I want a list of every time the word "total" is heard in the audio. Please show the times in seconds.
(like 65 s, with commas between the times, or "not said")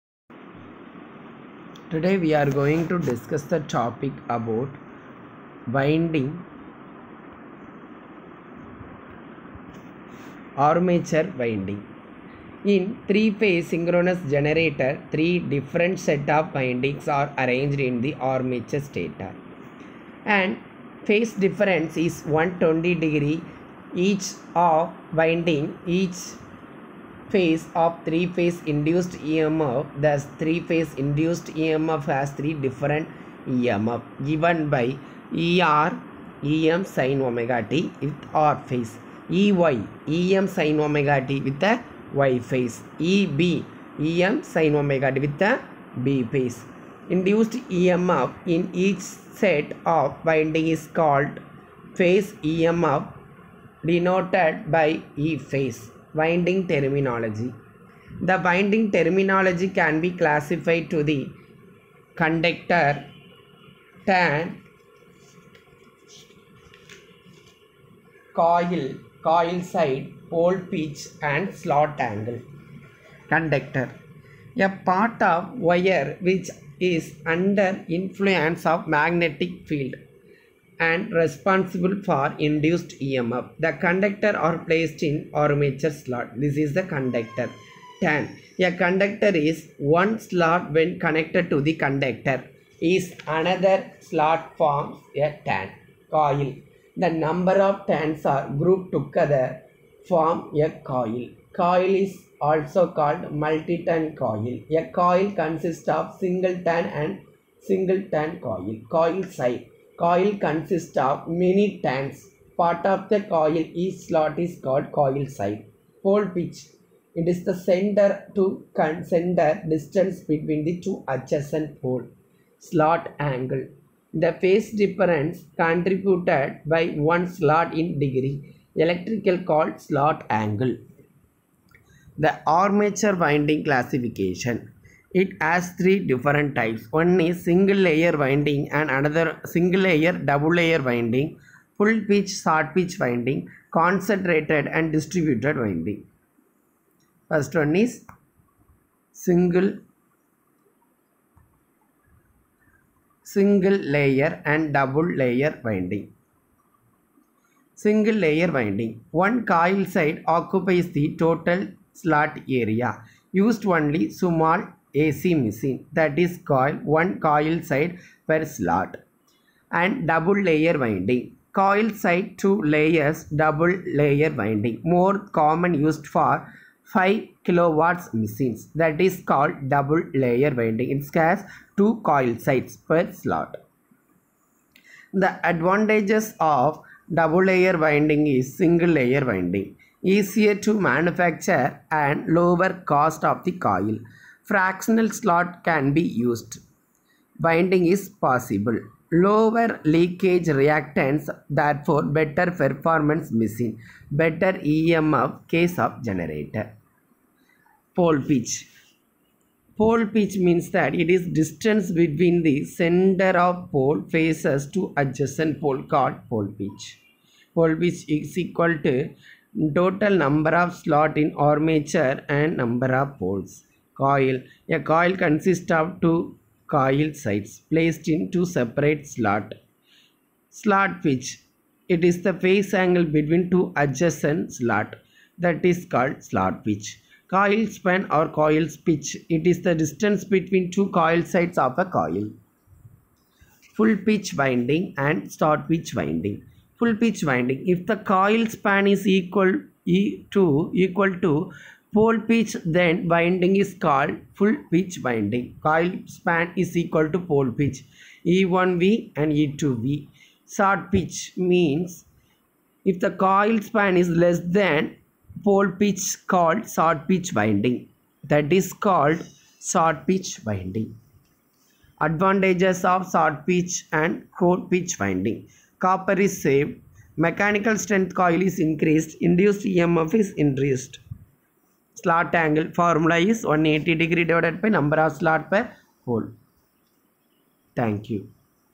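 161 s, 219 s.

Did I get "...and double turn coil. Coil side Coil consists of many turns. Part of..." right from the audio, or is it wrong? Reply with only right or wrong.
wrong.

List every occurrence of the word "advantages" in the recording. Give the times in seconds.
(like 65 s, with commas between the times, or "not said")
185 s, 271 s.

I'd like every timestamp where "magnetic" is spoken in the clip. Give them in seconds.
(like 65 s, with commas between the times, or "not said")
78 s.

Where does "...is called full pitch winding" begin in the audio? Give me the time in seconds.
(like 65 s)
253 s.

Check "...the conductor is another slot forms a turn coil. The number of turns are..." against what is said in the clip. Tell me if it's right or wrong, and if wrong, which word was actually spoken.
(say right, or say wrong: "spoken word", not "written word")
right.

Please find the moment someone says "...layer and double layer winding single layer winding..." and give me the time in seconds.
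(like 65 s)
153 s.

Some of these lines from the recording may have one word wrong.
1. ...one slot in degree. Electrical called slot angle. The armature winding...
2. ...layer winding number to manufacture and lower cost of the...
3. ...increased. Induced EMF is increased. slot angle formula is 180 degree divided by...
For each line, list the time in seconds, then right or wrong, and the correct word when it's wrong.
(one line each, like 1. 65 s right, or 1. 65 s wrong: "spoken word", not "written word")
1. 127 s right
2. 188 s wrong: "easier", not "number"
3. 278 s right.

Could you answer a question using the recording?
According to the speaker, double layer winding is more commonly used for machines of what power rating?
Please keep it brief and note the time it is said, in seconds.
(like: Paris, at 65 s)
5 kilowatts, at 176 s.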